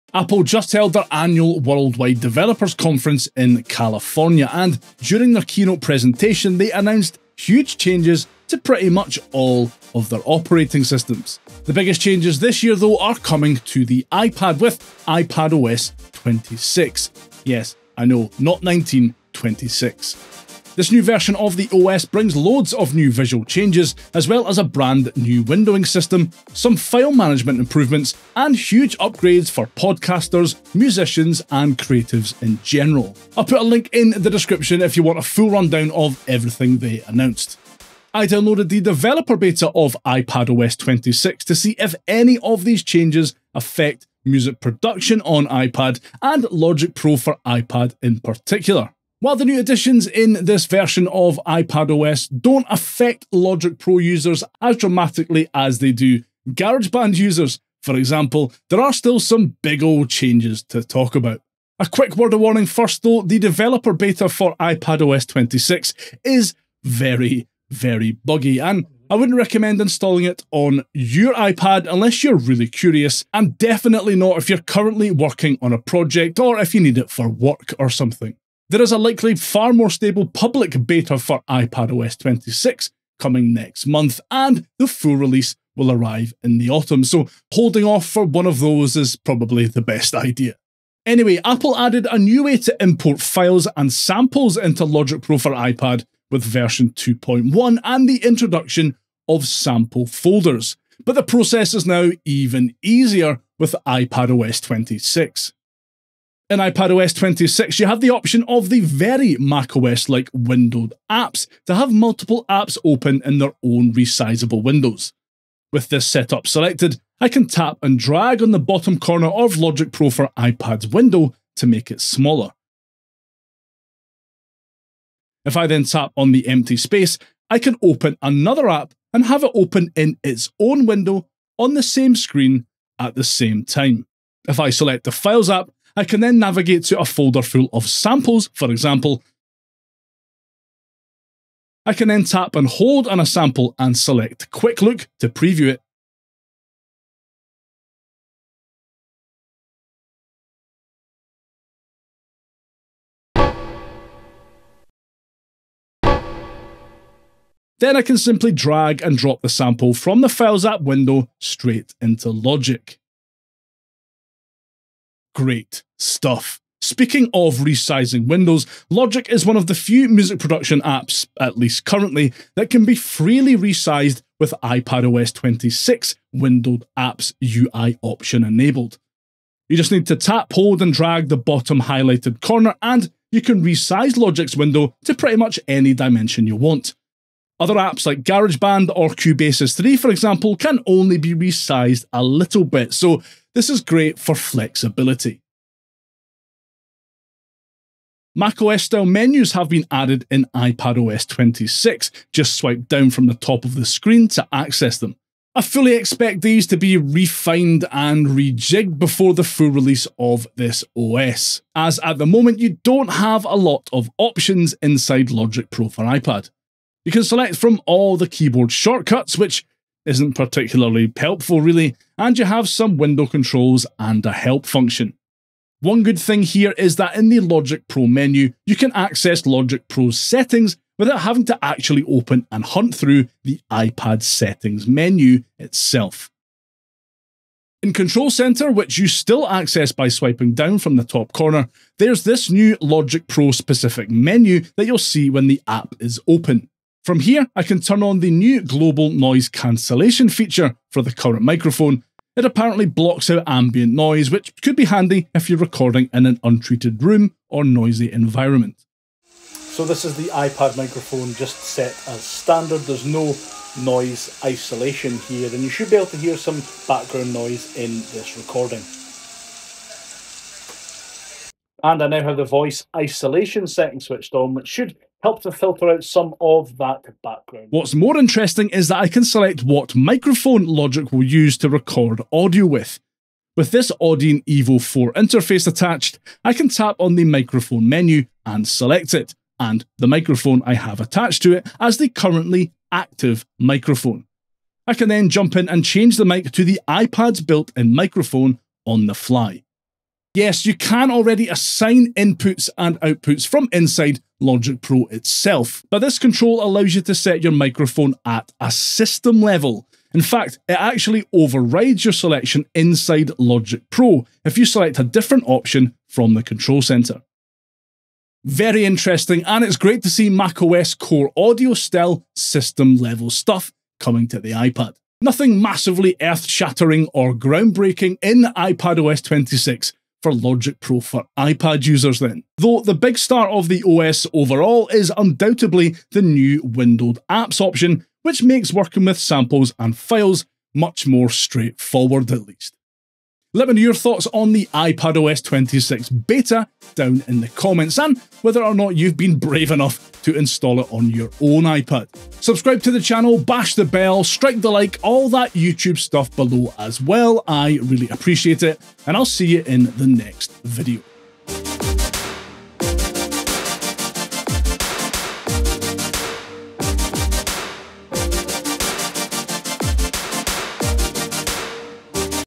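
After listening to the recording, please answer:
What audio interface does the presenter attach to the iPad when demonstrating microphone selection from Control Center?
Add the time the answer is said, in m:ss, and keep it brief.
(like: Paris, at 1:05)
Audient Evo 4, at 4:44.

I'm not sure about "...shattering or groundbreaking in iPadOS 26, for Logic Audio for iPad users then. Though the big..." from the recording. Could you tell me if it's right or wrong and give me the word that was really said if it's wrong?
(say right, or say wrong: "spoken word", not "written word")
wrong: "Pro", not "Audio".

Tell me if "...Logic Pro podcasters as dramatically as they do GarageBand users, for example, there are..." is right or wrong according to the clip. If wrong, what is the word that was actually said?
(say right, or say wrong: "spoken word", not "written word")
wrong: "users", not "podcasters".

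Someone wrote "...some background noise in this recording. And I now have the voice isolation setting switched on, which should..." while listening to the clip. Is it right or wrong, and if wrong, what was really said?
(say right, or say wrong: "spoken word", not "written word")
right.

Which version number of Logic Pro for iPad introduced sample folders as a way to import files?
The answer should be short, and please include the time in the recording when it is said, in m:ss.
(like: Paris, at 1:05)
2.1, at 1:36.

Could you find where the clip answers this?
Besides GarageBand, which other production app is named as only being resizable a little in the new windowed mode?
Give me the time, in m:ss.
3:09.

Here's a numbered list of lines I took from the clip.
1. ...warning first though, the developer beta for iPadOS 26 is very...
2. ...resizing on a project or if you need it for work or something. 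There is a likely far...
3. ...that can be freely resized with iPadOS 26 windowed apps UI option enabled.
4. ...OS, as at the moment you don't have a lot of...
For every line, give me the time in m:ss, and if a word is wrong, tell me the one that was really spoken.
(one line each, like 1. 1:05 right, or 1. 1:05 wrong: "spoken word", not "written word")
1. 1:02 right
2. 1:15 wrong: "working", not "resizing"
3. 2:52 right
4. 3:30 right.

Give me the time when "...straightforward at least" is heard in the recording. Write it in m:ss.
5:41.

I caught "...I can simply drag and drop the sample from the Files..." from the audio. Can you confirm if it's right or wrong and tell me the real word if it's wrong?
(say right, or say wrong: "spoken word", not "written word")
right.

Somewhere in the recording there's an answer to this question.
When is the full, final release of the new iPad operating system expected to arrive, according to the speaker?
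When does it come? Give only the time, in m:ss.
1:26.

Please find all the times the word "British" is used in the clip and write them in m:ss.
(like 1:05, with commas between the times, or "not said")
not said.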